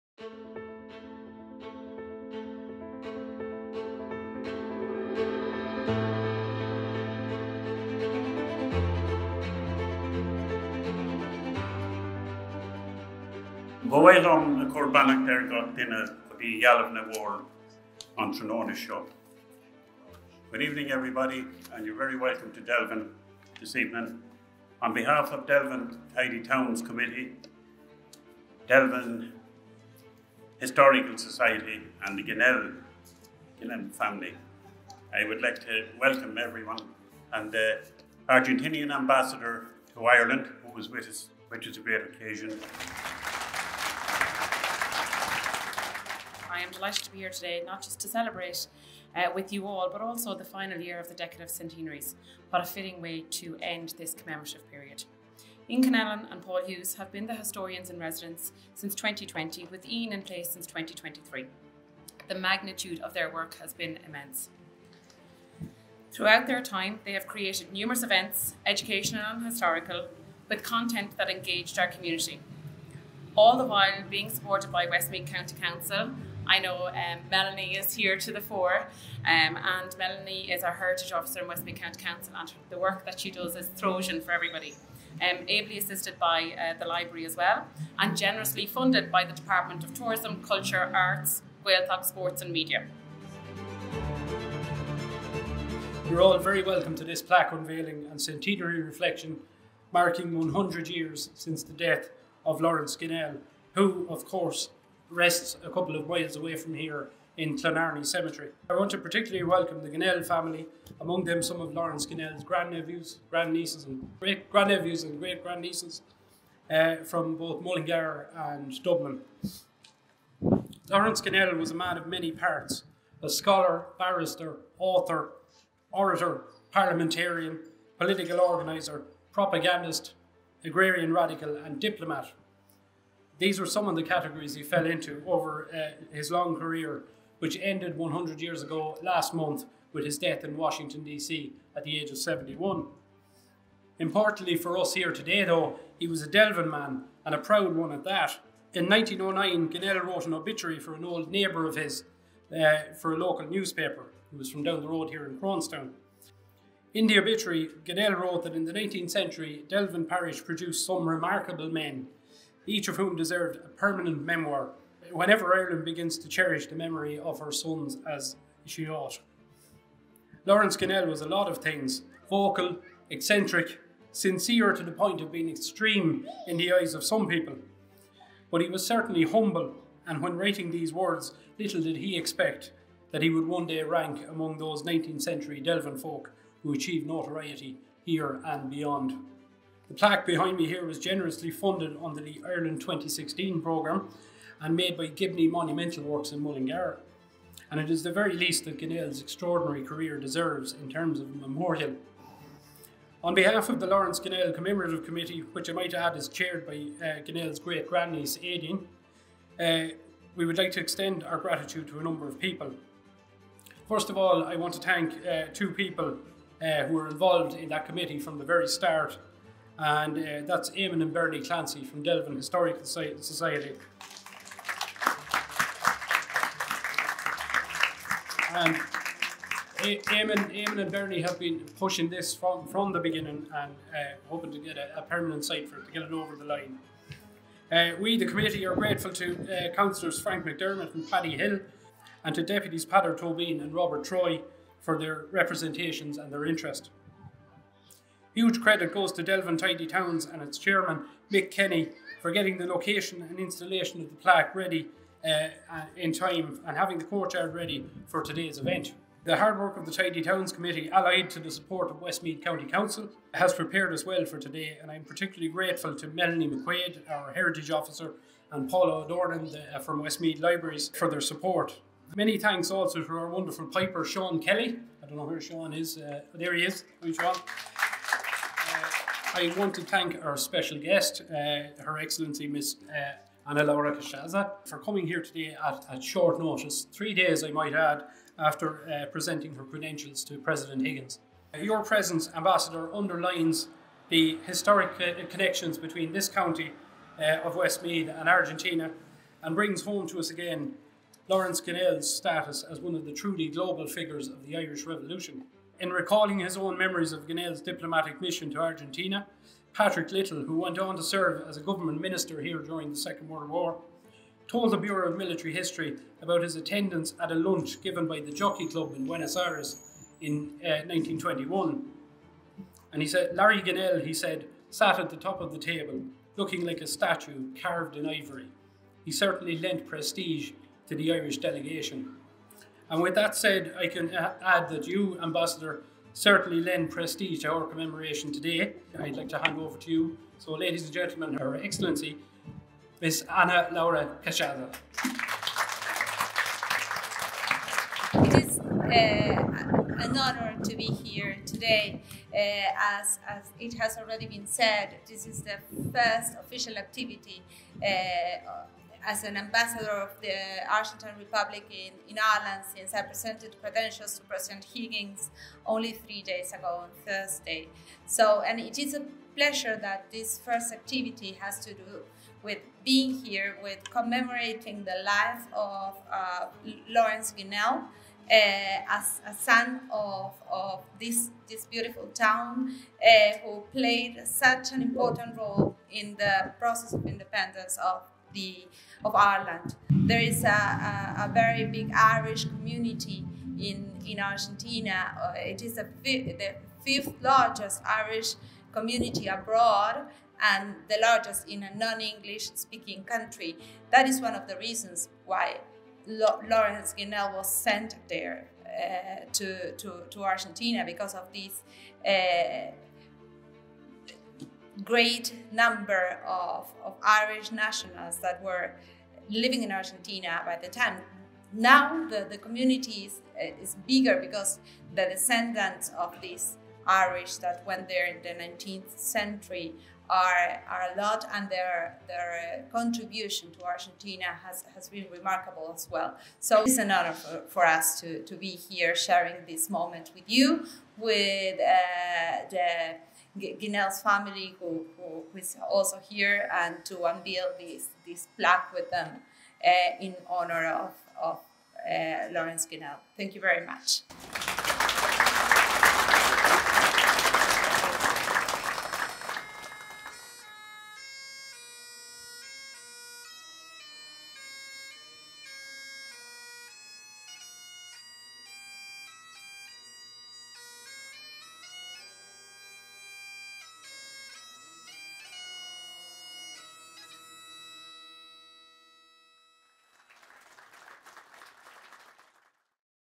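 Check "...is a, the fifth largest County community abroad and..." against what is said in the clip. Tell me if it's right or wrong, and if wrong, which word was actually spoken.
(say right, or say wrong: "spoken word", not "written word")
wrong: "Irish", not "County".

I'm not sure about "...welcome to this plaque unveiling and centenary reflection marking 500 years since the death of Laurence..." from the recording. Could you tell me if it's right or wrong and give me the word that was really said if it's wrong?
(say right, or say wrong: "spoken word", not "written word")
wrong: "100", not "500".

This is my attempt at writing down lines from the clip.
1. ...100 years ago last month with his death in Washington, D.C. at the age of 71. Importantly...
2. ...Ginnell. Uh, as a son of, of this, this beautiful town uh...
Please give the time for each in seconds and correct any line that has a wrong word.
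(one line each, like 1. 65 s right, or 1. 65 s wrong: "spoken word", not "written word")
1. 137 s right
2. 377 s right.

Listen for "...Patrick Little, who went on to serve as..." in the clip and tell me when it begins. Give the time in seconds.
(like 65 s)
309 s.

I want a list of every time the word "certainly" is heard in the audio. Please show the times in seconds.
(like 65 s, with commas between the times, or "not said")
178 s, 329 s, 336 s.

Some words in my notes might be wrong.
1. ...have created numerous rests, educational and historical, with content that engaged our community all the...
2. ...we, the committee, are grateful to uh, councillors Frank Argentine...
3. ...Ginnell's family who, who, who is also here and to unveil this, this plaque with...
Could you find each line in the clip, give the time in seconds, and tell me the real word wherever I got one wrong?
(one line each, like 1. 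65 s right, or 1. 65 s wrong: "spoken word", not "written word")
1. 67 s wrong: "events", not "rests"
2. 238 s wrong: "McDermott", not "Argentine"
3. 443 s right.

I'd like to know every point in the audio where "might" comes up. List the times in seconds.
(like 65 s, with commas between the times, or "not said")
205 s, 287 s.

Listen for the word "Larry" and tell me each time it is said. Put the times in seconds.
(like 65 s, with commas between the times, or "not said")
323 s.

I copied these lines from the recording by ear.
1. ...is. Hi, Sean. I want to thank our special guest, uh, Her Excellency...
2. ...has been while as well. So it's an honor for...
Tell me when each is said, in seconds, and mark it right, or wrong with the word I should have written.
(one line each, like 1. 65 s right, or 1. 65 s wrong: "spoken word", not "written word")
1. 276 s right
2. 434 s wrong: "remarkable", not "while".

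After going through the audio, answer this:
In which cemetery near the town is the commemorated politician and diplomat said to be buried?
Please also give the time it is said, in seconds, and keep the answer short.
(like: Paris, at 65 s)
Clonarney Cemetery, at 107 s.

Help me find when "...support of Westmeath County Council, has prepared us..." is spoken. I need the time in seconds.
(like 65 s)
261 s.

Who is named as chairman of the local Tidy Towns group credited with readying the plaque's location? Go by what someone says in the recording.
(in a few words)
Mick Kenny.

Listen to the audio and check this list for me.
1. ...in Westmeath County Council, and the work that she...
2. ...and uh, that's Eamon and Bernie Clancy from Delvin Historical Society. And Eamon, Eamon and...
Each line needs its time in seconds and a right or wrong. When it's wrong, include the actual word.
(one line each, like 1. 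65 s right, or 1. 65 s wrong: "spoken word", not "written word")
1. 81 s right
2. 219 s right.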